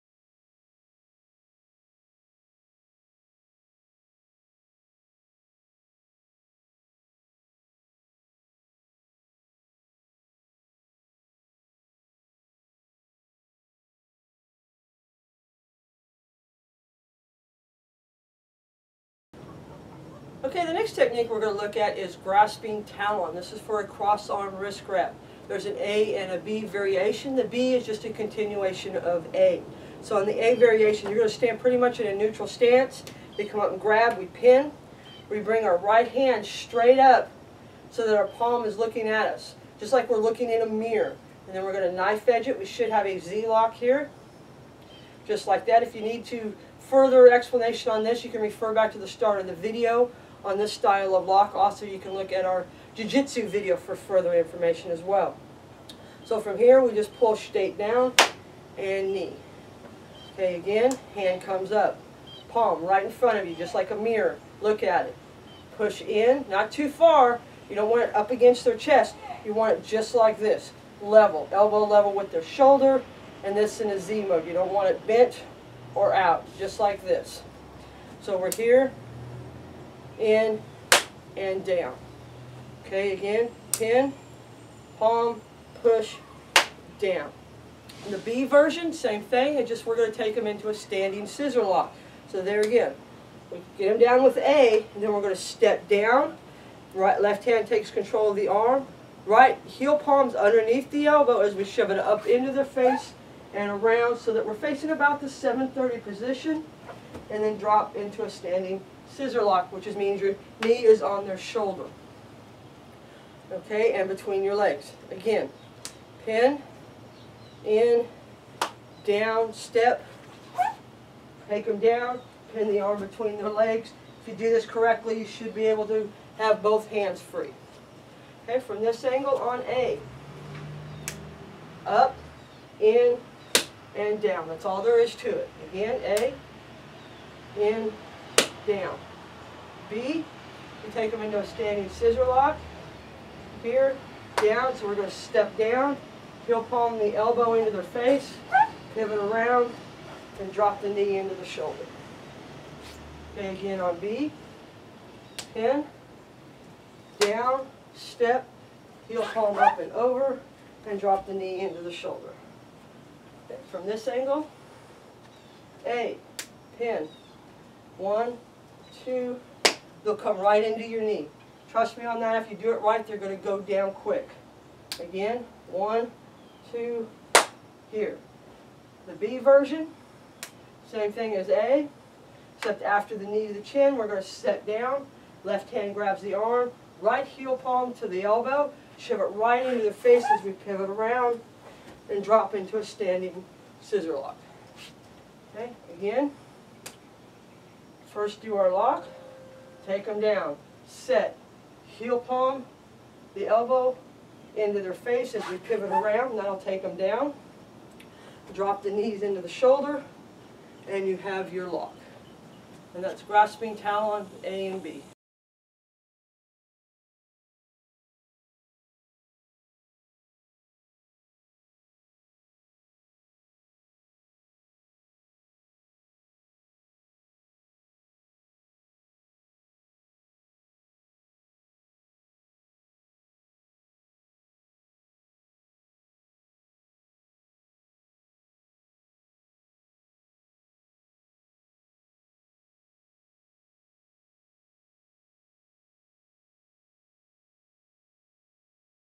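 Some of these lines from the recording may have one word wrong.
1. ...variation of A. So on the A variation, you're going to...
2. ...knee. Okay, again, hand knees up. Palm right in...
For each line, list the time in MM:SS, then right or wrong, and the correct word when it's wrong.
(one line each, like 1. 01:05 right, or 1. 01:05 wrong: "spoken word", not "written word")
1. 00:28 wrong: "continuation", not "variation"
2. 00:59 wrong: "comes", not "knees".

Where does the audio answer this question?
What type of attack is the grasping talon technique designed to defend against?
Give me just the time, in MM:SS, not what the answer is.
00:23.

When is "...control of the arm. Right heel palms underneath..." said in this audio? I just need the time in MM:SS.
01:37.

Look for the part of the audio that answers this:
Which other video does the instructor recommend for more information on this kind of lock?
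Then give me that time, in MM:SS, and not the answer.
00:52.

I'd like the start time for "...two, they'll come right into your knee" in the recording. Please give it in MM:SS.
02:49.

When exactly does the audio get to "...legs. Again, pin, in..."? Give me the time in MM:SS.
01:54.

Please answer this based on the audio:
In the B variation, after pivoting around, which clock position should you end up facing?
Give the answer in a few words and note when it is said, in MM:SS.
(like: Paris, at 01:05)
7:30, at 01:45.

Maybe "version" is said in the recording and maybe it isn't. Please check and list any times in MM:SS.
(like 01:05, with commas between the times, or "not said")
01:28, 02:59.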